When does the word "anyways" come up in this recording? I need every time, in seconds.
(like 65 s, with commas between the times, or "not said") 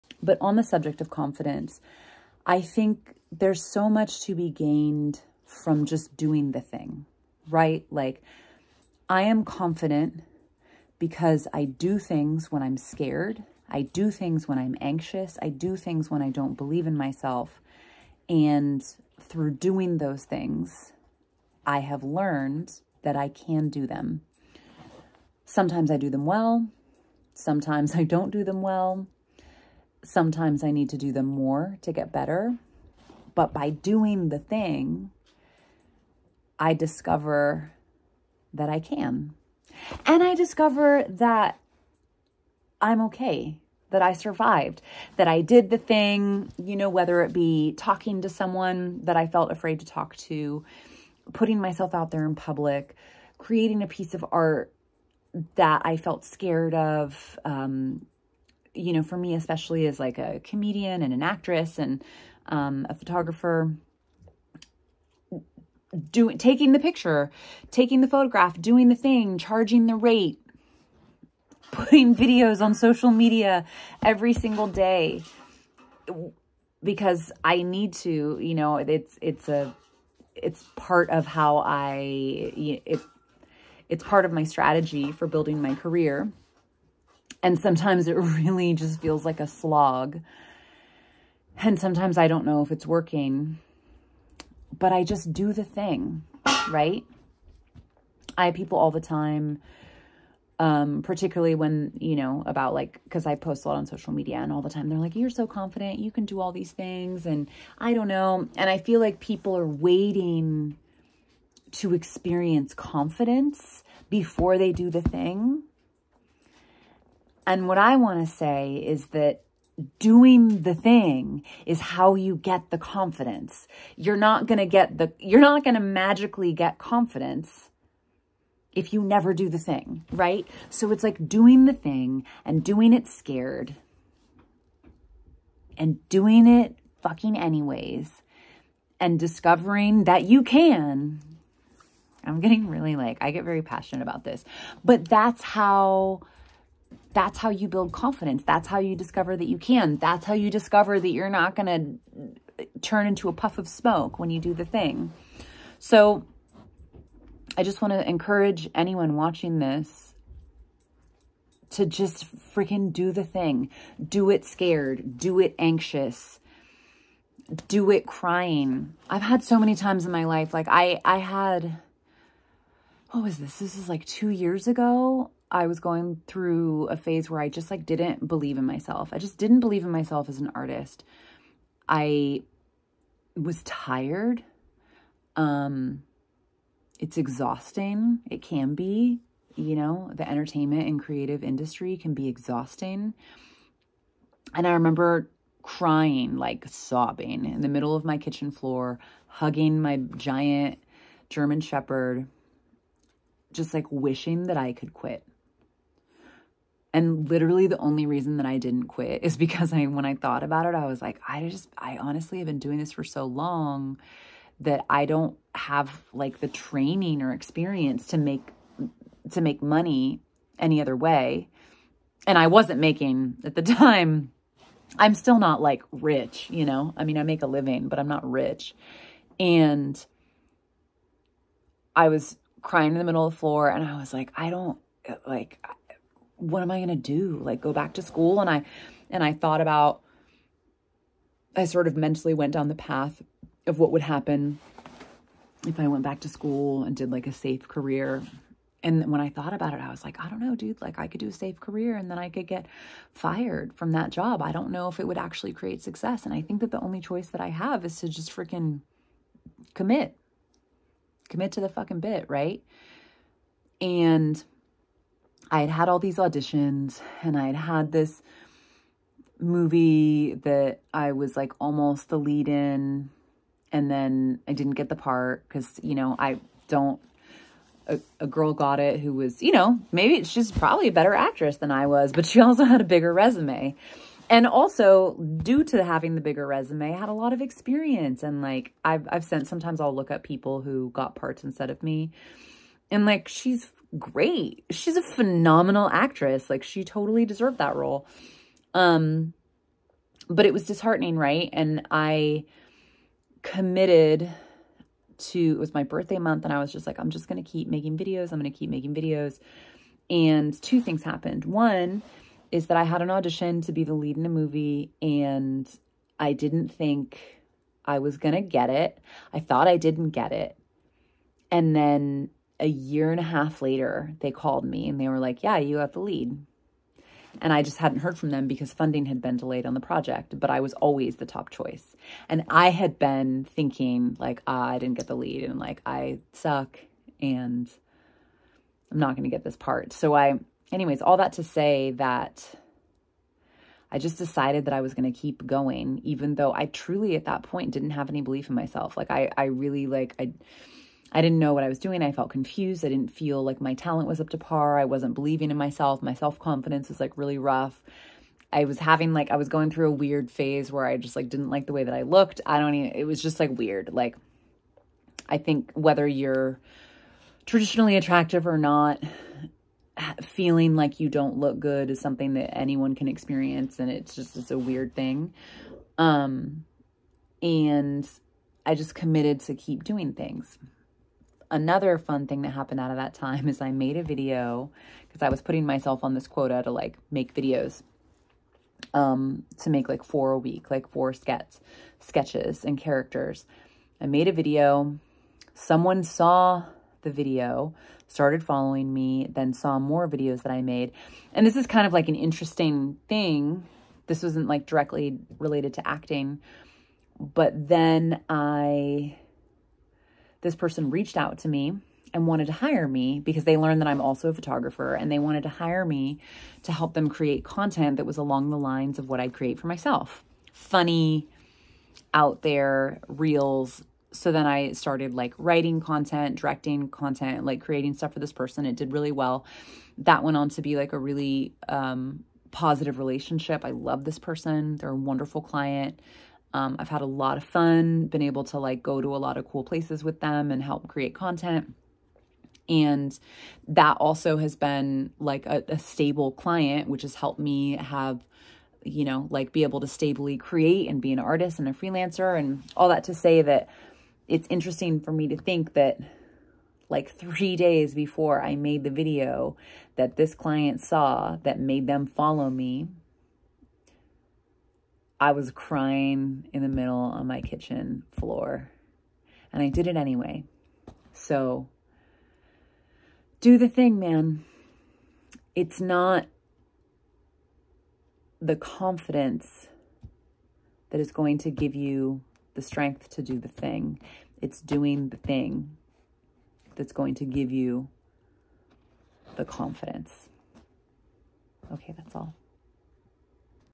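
137 s, 340 s, 469 s.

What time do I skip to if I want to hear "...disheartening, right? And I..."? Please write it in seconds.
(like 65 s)
300 s.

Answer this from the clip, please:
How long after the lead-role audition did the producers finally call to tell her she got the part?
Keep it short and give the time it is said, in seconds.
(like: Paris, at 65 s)
a year and a half, at 322 s.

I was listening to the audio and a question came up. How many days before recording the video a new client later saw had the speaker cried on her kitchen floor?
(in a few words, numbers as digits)
3.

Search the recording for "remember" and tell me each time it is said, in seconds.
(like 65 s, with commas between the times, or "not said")
194 s.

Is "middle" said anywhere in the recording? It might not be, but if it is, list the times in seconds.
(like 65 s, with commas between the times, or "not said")
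197 s, 233 s, 466 s.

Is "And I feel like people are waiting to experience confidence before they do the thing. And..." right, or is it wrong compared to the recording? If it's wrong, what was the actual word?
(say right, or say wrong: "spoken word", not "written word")
right.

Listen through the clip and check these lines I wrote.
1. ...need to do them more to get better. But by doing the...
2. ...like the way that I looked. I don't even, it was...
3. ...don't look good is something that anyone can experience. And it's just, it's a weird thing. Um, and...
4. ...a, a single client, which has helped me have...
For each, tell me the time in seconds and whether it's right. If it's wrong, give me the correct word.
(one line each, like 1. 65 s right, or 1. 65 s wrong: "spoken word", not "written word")
1. 30 s right
2. 361 s right
3. 371 s right
4. 445 s wrong: "stable", not "single".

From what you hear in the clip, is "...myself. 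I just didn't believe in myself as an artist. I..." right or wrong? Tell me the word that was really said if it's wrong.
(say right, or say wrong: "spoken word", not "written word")
right.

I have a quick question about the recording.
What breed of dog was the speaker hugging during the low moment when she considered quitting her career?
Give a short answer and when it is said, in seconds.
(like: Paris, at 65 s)
German Shepherd, at 201 s.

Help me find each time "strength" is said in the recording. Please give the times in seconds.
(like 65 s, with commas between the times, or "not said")
482 s.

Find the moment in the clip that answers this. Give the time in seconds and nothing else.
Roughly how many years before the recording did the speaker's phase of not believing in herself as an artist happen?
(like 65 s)
174 s.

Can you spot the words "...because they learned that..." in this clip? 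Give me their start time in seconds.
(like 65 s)
413 s.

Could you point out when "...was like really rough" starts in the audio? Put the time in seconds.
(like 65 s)
356 s.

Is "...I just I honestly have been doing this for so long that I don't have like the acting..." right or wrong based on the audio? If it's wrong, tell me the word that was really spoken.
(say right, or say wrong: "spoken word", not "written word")
wrong: "training", not "acting".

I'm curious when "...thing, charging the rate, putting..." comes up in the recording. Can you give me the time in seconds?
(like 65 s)
68 s.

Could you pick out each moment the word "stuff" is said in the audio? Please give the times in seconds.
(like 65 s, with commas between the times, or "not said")
427 s.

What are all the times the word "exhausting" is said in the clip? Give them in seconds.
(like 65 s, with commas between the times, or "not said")
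187 s, 192 s.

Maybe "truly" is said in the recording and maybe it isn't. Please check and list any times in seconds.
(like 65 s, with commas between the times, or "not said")
346 s.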